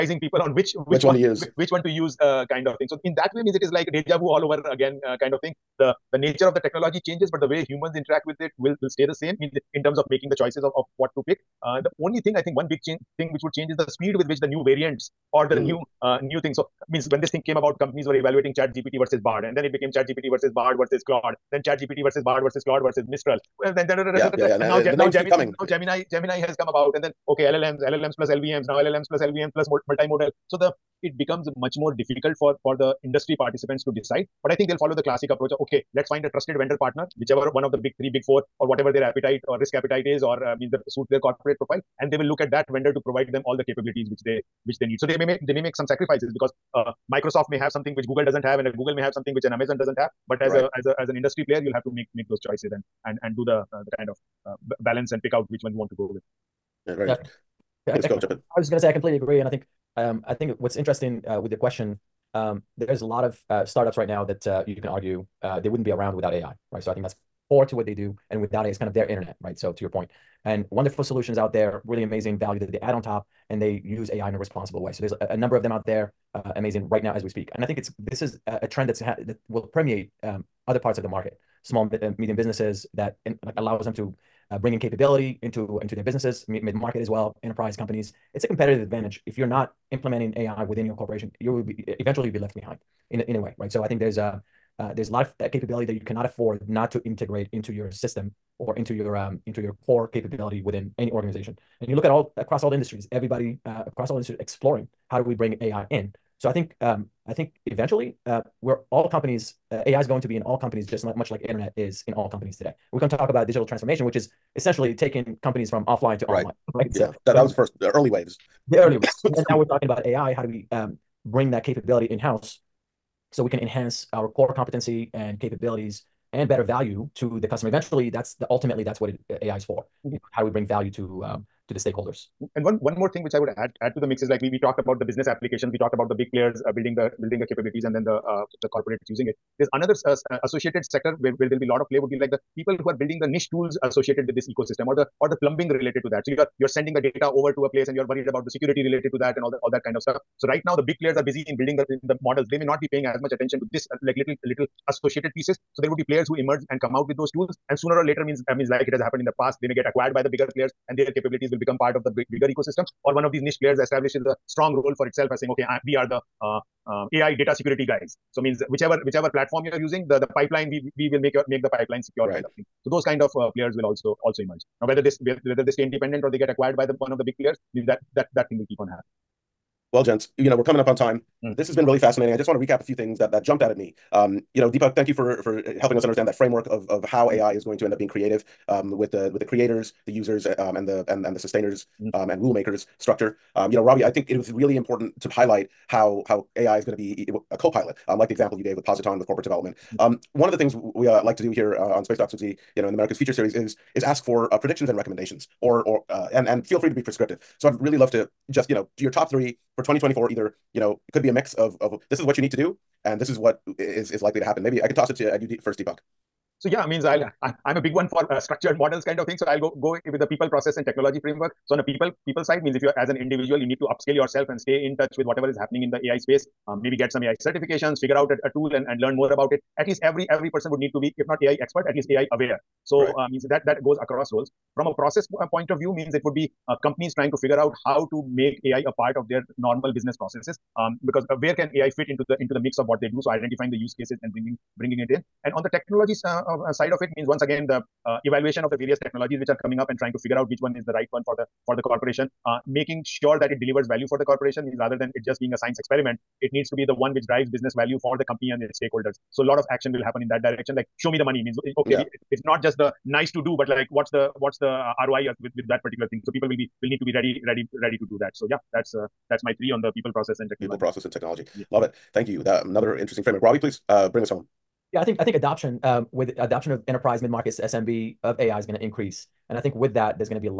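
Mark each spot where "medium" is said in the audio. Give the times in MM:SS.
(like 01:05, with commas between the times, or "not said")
01:22.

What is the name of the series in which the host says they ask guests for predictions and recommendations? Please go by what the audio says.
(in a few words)
America's Future.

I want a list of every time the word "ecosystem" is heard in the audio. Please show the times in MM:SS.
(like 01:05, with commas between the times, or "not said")
02:24, 02:42.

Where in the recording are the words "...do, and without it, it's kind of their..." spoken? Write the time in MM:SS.
01:07.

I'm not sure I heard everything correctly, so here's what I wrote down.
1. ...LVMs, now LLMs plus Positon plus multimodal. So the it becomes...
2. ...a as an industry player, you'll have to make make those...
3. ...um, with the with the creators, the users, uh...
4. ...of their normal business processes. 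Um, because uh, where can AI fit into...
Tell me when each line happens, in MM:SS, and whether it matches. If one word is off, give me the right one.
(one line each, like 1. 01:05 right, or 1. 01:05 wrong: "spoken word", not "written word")
1. 00:28 wrong: "LVMs", not "Positon"
2. 00:50 right
3. 03:08 right
4. 03:59 right.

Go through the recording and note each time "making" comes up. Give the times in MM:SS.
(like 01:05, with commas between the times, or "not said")
00:10, 04:12.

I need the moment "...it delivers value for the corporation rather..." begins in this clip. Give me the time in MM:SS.
04:13.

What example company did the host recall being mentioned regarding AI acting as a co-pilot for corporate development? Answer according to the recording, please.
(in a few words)
Positon.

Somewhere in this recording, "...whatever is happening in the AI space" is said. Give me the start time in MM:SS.
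03:45.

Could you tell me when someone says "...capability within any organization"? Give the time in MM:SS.
01:40.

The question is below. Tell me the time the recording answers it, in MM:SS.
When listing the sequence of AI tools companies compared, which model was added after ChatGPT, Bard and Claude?
00:23.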